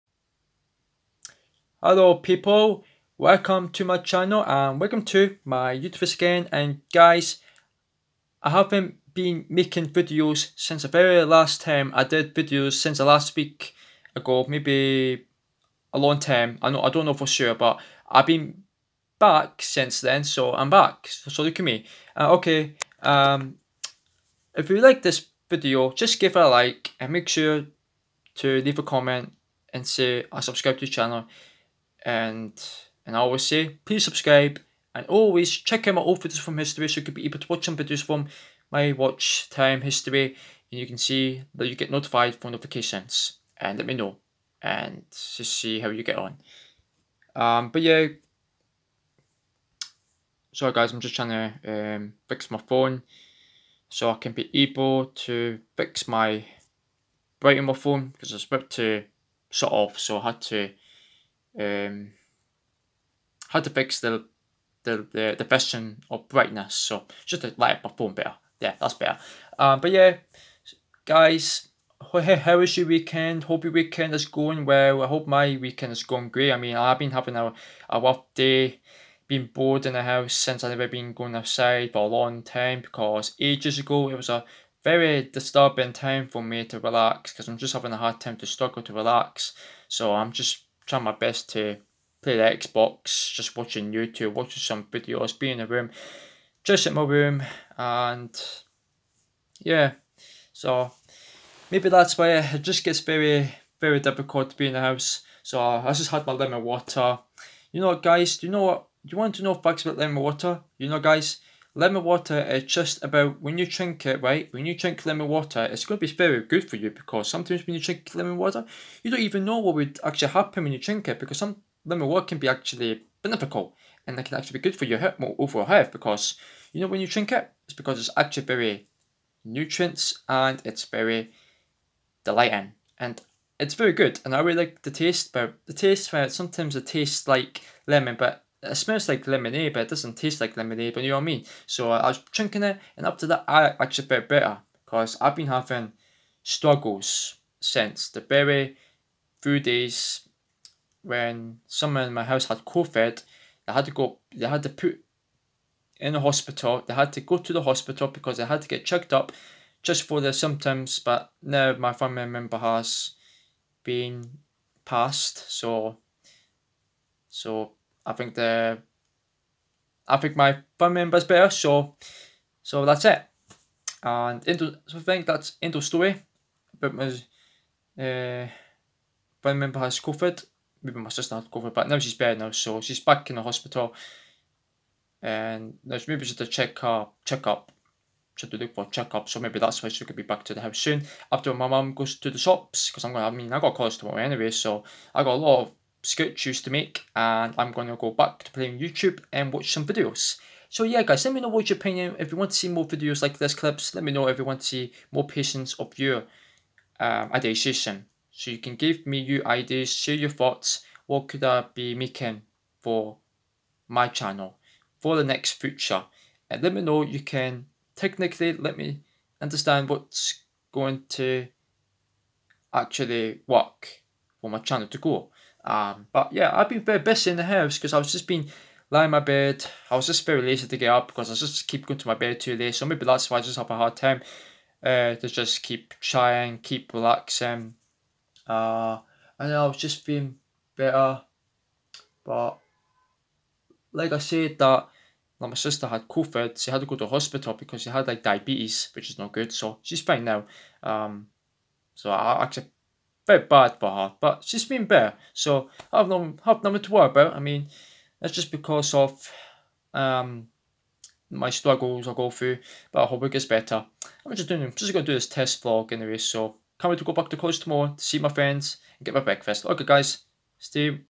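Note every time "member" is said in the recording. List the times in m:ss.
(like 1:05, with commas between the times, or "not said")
2:42, 2:51, 2:59.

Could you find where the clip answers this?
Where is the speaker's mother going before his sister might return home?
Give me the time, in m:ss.
3:12.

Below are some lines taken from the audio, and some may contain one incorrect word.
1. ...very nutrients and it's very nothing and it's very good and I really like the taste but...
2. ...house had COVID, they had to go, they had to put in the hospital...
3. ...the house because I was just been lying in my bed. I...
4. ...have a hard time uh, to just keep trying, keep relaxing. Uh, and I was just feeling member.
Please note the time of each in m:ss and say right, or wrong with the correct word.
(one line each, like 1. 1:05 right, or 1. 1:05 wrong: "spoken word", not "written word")
1. 2:08 wrong: "delighting", not "nothing"
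2. 2:32 right
3. 3:47 right
4. 3:53 wrong: "better", not "member".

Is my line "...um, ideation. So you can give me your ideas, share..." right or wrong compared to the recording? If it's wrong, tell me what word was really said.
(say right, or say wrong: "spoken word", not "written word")
right.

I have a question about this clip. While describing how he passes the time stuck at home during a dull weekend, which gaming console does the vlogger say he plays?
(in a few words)
Xbox.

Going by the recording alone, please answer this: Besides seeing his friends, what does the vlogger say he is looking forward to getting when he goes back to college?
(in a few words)
Breakfast.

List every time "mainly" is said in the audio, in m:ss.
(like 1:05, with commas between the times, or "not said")
not said.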